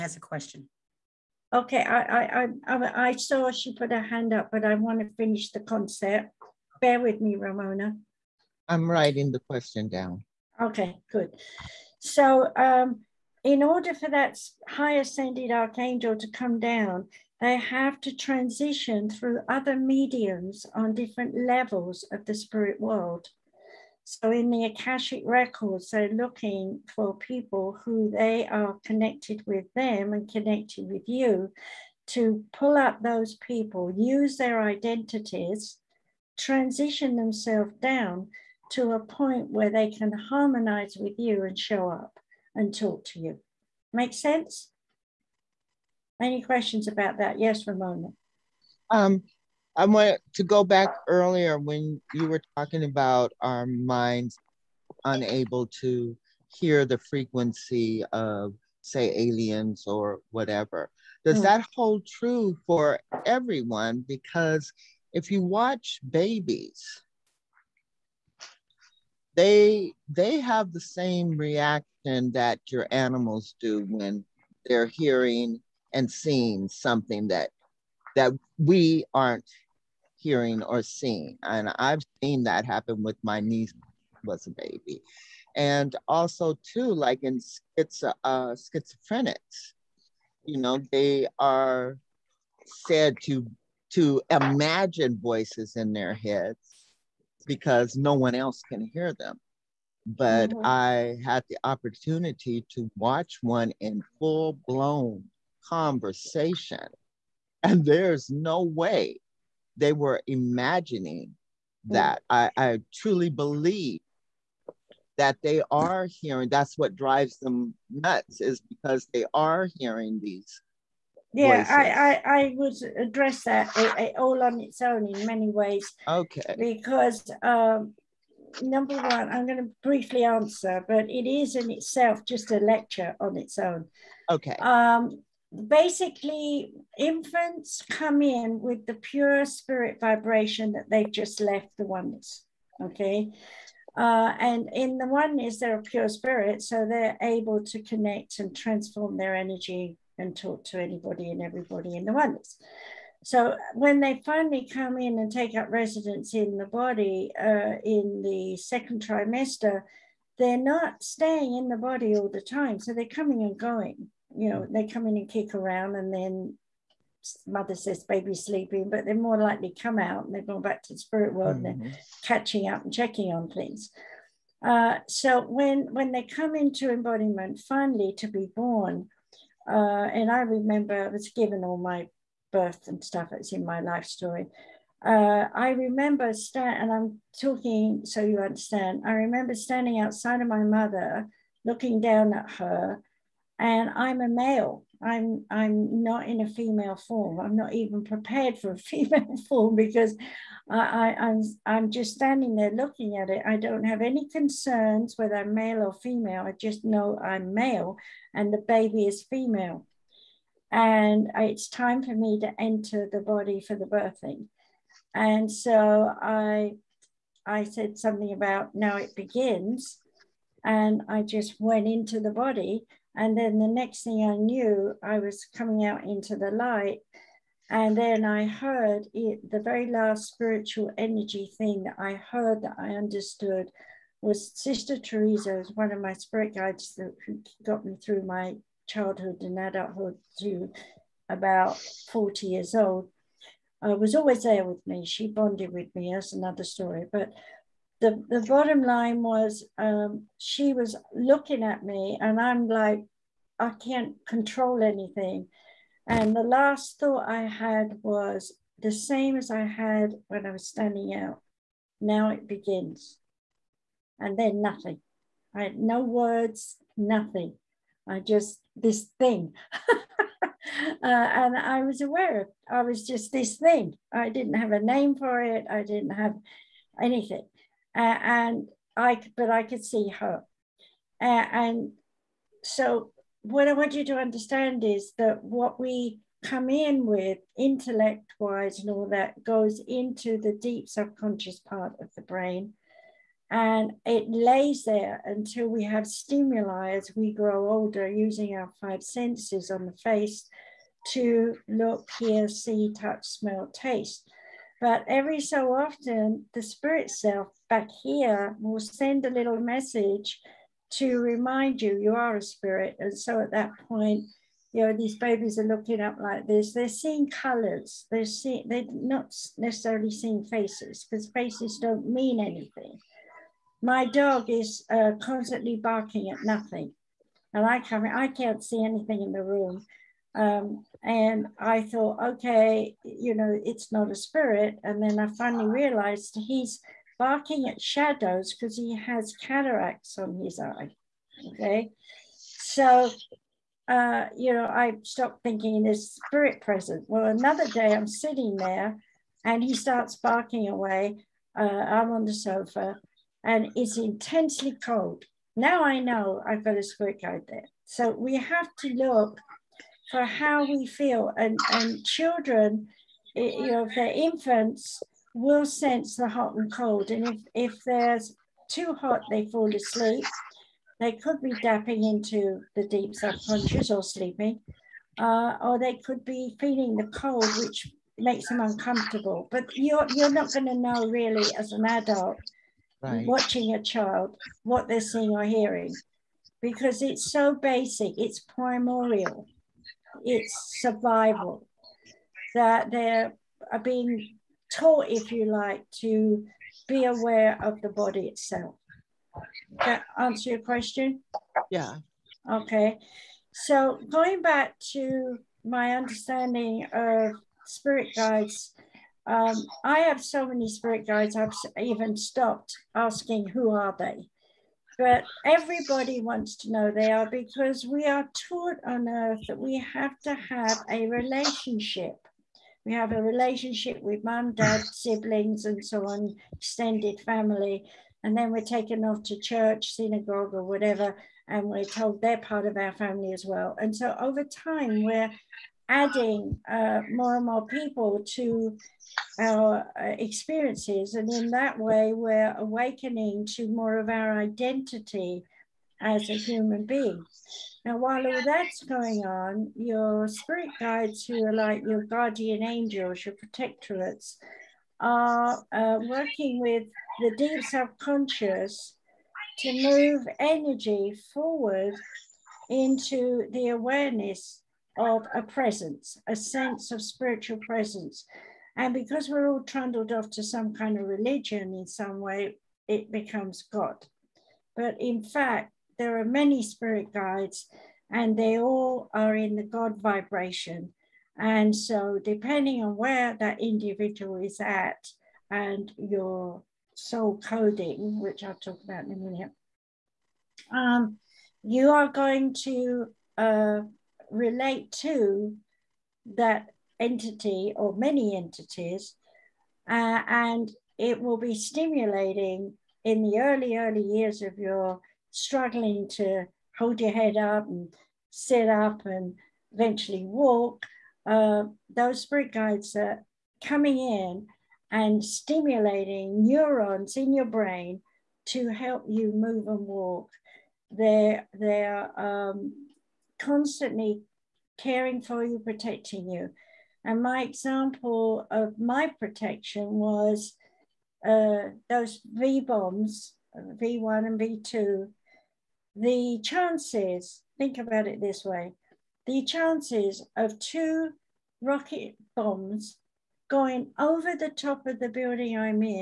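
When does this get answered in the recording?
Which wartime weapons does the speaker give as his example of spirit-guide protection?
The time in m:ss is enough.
8:53.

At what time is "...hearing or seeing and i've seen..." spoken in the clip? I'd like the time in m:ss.
1:20.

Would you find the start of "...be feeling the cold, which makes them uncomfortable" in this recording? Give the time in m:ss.
6:16.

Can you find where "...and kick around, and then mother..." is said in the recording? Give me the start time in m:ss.
2:45.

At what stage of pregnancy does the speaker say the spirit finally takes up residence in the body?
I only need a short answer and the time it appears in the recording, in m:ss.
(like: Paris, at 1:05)
second trimester, at 2:38.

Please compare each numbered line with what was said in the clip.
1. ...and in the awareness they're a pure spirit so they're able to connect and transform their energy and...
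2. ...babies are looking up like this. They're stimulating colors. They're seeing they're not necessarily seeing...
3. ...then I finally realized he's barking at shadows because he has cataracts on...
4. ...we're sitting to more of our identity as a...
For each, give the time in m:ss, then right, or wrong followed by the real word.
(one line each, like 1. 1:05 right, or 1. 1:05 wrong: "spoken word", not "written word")
1. 2:24 wrong: "oneness", not "awareness"
2. 5:15 wrong: "seeing", not "stimulating"
3. 5:35 right
4. 7:22 wrong: "awakening", not "sitting".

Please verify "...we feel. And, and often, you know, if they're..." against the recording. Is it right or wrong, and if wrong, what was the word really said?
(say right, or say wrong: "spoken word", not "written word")
wrong: "children", not "often".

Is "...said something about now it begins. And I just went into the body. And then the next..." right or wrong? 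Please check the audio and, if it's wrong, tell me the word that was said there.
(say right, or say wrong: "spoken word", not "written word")
right.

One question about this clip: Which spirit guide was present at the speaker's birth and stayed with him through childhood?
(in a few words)
Sister Teresa.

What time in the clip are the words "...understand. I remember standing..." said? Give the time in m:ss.
3:08.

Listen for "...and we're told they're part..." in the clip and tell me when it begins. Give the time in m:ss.
7:11.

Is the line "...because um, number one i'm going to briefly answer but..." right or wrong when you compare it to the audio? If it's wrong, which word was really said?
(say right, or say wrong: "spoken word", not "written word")
right.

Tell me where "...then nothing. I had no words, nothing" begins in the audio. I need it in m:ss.
4:24.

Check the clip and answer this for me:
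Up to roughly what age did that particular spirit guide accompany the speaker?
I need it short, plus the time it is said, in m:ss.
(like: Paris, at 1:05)
40, at 4:02.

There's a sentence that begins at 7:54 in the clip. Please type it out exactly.
But in fact, there are many spirit guides and they all are in the God vibration.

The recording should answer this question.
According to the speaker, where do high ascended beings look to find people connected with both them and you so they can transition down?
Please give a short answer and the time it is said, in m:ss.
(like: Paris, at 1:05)
Akashic records, at 0:24.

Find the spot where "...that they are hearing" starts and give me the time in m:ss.
1:55.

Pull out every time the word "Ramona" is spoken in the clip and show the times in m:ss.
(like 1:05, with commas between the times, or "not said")
0:07, 0:47.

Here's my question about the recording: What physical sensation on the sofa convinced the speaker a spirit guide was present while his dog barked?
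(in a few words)
intensely cold.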